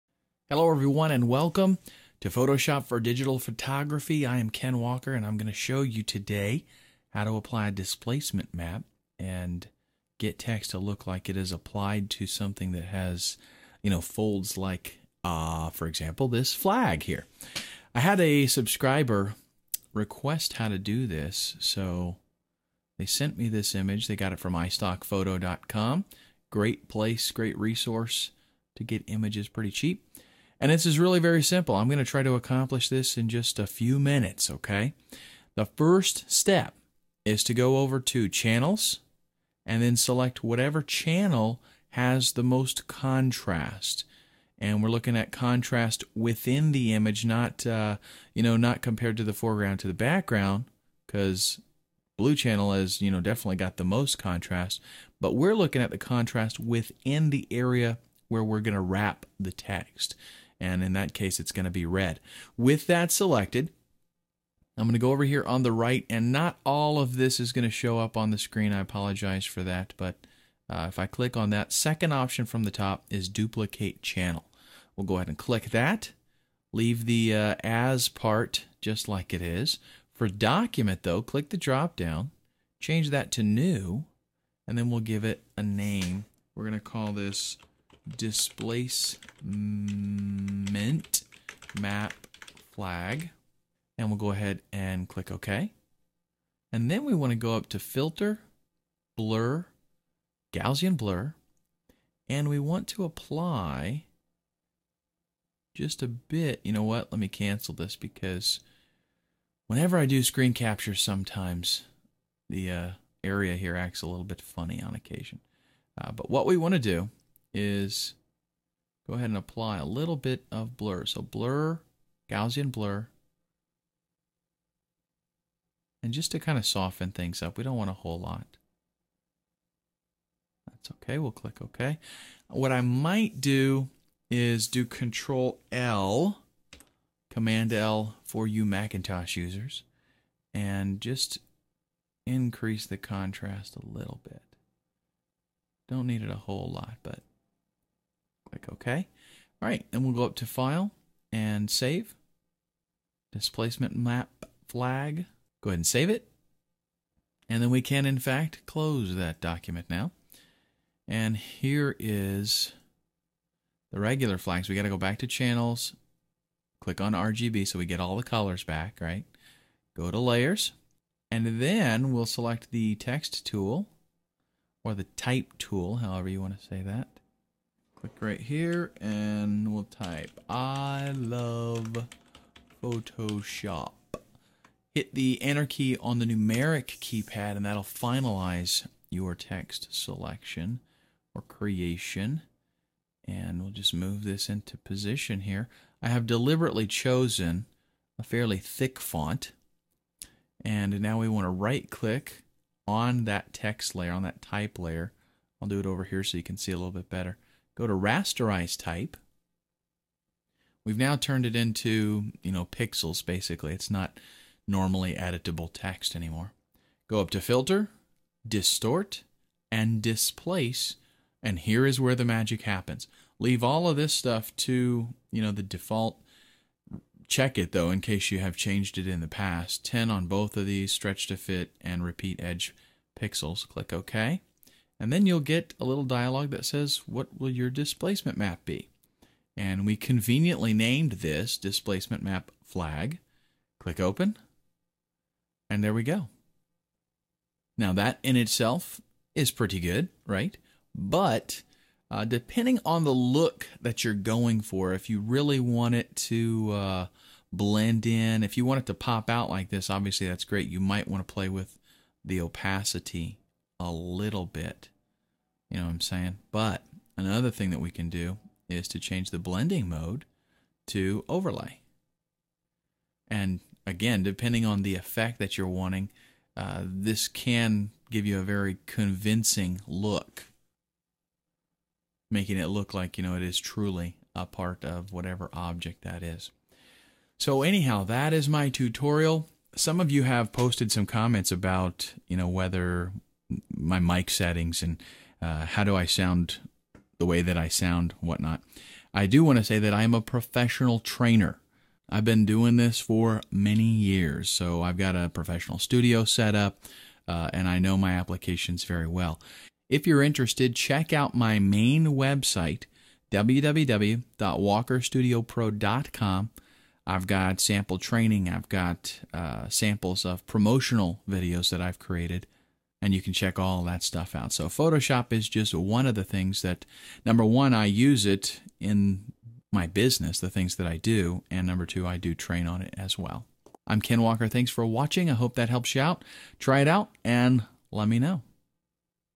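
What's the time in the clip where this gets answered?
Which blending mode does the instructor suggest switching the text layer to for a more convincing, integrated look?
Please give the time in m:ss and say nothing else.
4:31.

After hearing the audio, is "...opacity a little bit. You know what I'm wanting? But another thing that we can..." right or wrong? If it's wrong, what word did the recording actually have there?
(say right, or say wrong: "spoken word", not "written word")
wrong: "saying", not "wanting".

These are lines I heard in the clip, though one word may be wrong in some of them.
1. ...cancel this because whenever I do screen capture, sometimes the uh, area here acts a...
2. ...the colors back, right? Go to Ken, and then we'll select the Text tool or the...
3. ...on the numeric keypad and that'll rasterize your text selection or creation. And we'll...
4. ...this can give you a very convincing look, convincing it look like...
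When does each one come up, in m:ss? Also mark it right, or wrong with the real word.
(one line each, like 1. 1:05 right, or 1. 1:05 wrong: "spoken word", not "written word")
1. 1:47 right
2. 2:48 wrong: "Layers", not "Ken"
3. 3:05 wrong: "finalize", not "rasterize"
4. 4:36 wrong: "making", not "convincing".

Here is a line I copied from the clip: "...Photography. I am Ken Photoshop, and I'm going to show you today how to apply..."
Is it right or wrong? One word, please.
wrong.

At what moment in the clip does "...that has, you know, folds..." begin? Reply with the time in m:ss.
0:12.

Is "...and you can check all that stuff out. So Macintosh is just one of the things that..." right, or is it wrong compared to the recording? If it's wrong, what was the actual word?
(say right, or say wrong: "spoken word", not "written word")
wrong: "Photoshop", not "Macintosh".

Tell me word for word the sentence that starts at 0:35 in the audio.
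The first step is to go over to Channels and then select whatever channel has the most contrast.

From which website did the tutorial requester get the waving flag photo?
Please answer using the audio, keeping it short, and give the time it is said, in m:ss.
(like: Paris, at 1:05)
iStockPhoto.com, at 0:24.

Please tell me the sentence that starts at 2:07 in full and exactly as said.
We don't want a whole lot.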